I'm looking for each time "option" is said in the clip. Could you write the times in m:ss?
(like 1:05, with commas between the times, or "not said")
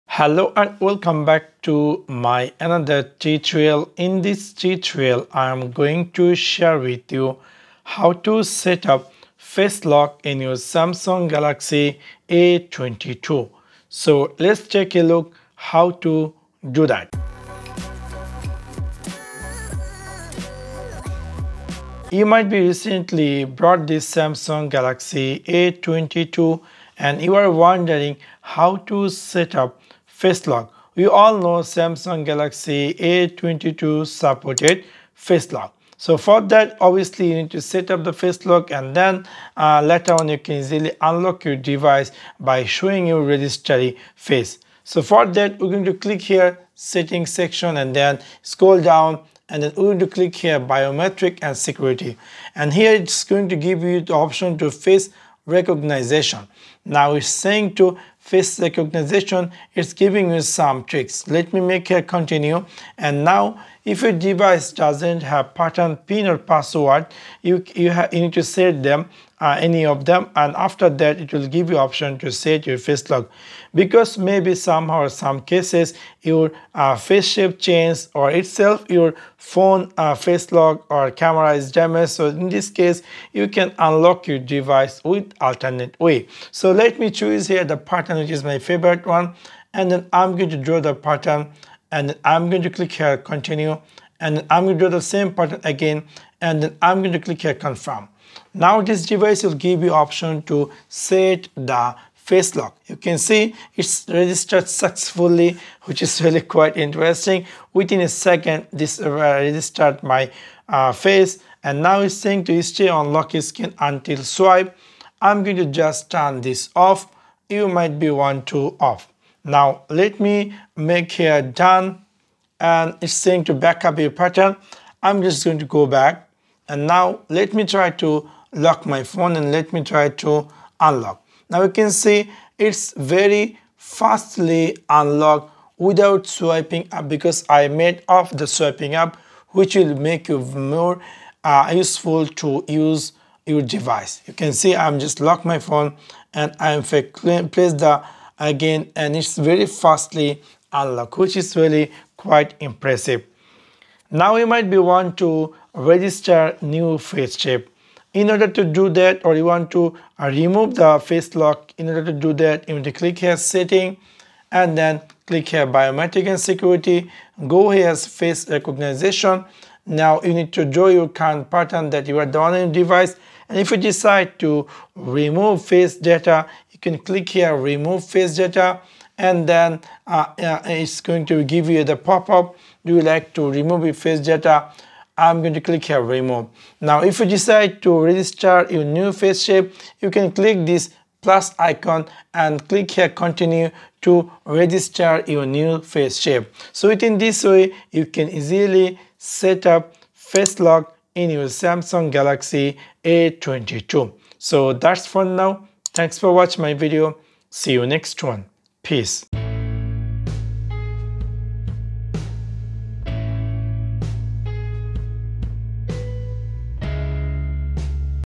0:54, 1:11, 1:39.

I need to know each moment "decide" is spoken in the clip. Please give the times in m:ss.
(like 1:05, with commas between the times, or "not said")
2:53, 3:07.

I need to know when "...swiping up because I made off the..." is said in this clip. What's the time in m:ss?
2:16.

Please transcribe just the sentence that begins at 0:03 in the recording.
In this tutorial, I am going to share with you how to set up face lock in your Samsung Galaxy A22.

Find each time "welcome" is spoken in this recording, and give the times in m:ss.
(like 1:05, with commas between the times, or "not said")
0:00.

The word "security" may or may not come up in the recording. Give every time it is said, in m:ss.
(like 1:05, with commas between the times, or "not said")
0:51, 2:46.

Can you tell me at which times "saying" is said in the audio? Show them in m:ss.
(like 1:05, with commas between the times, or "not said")
0:57, 1:52, 2:03.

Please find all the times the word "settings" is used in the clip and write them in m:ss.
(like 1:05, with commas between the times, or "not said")
0:46, 2:43.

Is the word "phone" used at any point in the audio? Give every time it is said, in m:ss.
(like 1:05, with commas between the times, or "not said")
1:19, 2:09, 2:25.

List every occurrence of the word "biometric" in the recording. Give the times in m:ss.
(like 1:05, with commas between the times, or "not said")
0:50, 2:45.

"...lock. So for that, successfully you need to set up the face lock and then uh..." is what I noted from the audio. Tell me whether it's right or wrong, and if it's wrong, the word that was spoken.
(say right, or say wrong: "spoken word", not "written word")
wrong: "obviously", not "successfully".